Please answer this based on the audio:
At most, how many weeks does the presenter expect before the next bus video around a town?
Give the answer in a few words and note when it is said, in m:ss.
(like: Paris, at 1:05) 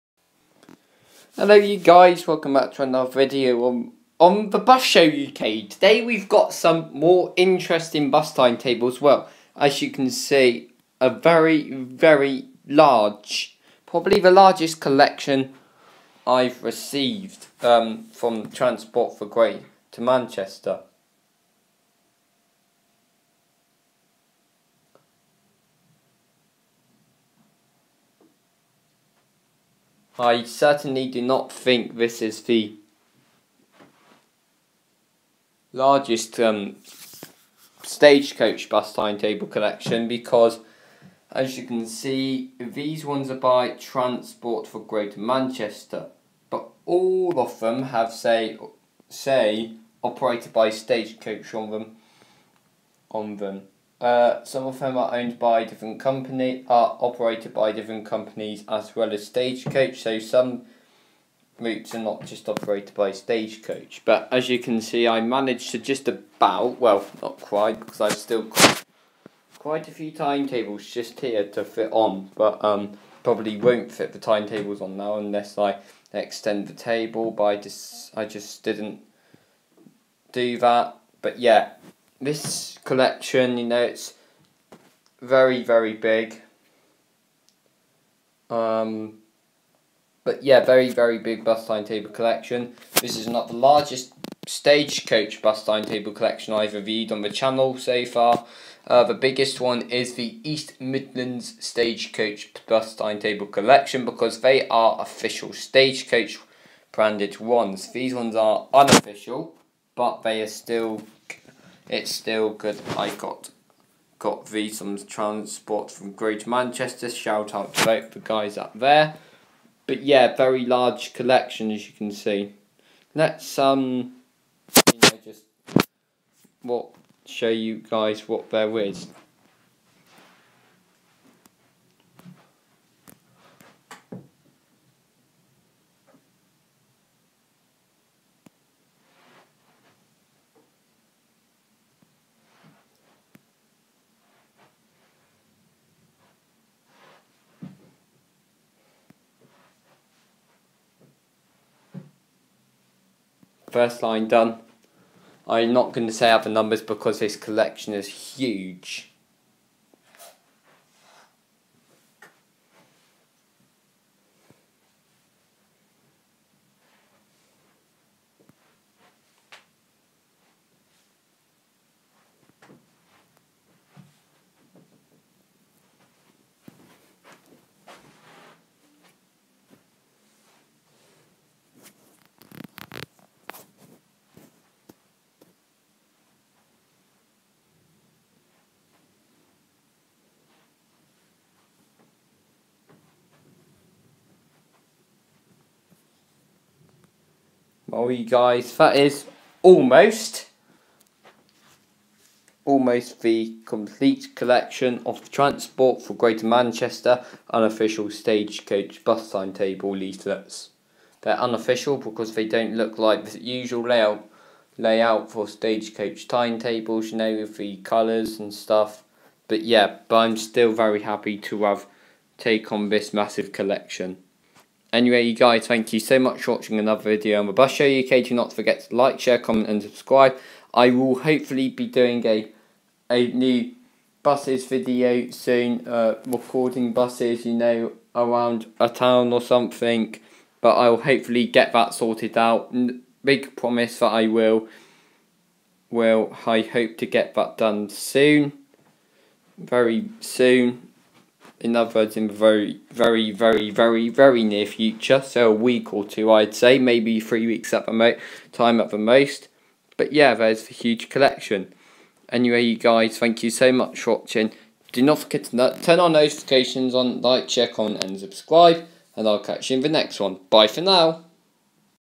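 3, at 4:17.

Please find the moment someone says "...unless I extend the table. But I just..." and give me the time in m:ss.
1:15.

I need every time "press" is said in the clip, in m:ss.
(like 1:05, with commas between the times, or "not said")
not said.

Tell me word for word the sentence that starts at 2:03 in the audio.
Let's um, you know, just what show you guys what there is.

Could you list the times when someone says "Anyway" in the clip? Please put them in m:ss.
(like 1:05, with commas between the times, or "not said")
3:44, 4:22.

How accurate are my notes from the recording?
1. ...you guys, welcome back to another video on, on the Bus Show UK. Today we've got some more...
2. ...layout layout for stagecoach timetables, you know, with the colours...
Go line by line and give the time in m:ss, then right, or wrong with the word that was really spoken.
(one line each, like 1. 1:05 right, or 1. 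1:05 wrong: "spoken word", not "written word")
1. 0:01 right
2. 3:33 right.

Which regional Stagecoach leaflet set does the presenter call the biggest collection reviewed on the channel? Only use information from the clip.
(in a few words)
East Midlands.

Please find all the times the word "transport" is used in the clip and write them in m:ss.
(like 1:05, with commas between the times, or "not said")
0:18, 0:43, 1:55, 3:25.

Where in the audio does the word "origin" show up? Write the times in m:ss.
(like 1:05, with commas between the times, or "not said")
not said.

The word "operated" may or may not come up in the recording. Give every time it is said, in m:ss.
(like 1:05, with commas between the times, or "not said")
0:50, 0:56, 1:02.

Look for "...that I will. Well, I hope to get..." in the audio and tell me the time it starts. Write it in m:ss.
4:03.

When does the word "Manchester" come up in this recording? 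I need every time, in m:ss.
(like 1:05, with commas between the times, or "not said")
0:20, 0:45, 1:56, 3:26.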